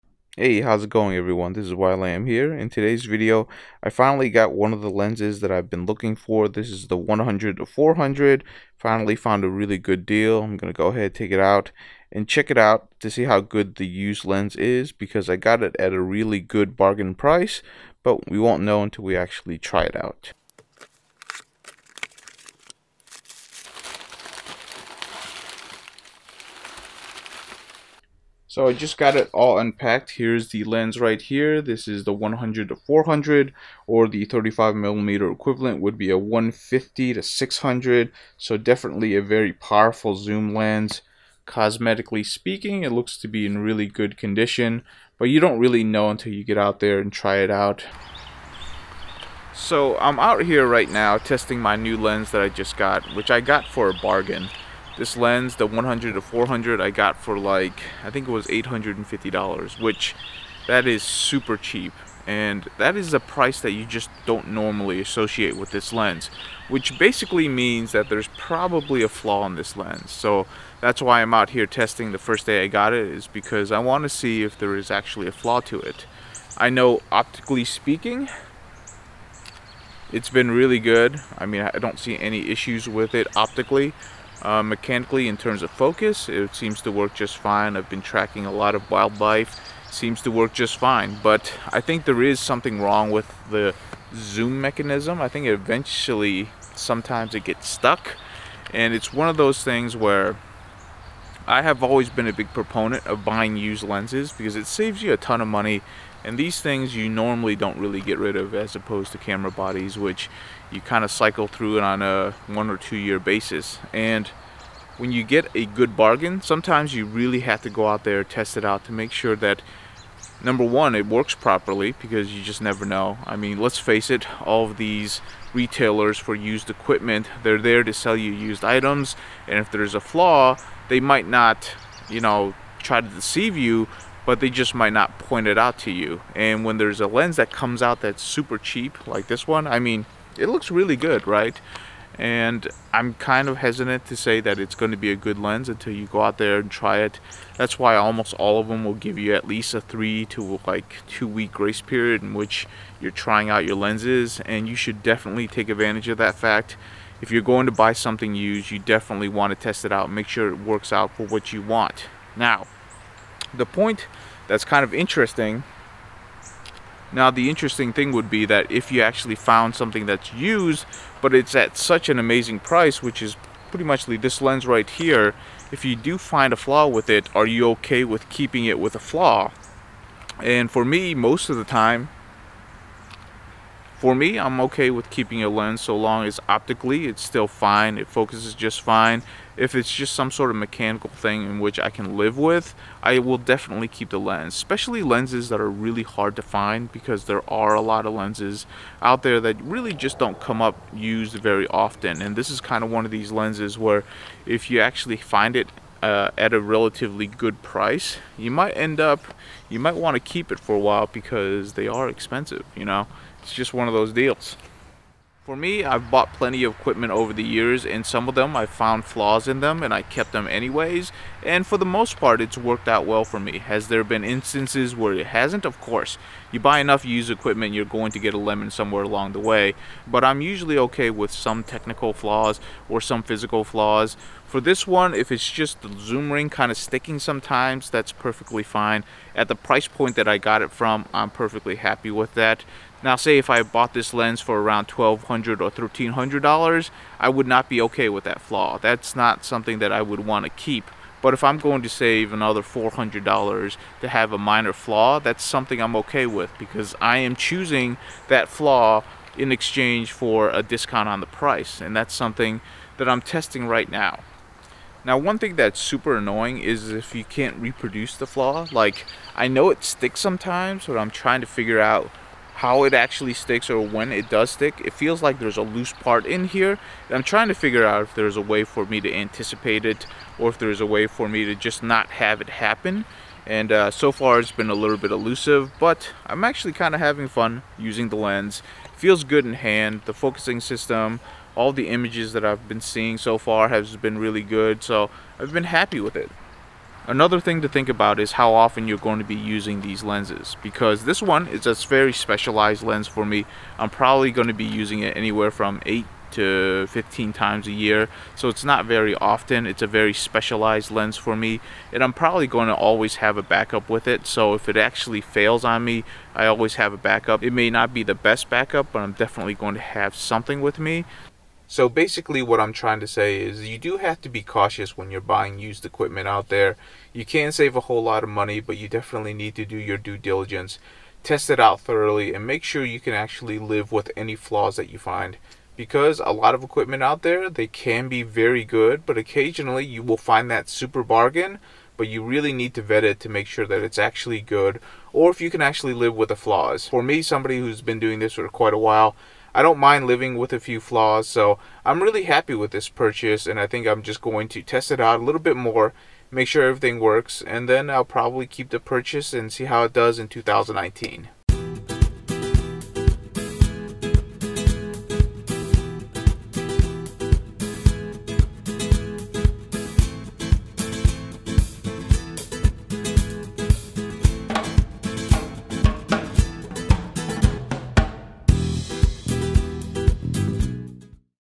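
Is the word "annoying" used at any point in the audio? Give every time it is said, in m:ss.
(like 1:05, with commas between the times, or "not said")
4:26.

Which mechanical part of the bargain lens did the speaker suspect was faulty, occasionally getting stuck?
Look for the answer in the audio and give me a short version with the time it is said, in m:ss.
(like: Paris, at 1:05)
zoom mechanism, at 1:34.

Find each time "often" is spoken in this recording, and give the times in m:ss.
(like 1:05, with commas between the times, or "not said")
3:21, 4:58, 5:09.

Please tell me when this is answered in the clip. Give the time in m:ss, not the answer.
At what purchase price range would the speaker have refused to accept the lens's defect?
4:04.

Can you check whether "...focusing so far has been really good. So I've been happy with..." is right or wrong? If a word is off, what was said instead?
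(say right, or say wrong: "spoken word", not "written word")
wrong: "seeing", not "focusing".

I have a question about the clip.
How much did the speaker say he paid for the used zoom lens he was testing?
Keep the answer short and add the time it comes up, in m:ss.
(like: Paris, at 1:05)
$850, at 0:58.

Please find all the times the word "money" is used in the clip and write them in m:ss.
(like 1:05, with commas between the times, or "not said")
1:45, 5:28.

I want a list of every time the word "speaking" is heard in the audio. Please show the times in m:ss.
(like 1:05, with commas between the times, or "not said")
0:42, 1:17.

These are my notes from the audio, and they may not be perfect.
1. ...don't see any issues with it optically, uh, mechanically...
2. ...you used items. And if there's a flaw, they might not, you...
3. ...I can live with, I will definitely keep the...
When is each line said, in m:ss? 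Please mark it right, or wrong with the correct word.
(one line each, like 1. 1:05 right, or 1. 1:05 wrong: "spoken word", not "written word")
1. 1:21 right
2. 2:08 right
3. 3:11 right.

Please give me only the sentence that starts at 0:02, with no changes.
In today's video, I finally got one of the lenses that I've been looking for.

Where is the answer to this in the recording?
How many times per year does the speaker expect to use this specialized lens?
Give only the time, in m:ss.
5:05.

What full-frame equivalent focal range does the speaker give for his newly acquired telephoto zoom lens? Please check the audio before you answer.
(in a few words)
150 to 600.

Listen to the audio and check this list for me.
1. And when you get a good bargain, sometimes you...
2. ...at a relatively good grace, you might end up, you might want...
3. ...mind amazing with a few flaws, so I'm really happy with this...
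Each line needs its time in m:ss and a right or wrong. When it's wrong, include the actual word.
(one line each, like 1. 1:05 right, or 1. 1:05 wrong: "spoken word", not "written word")
1. 1:53 right
2. 3:26 wrong: "price", not "grace"
3. 5:49 wrong: "living", not "amazing".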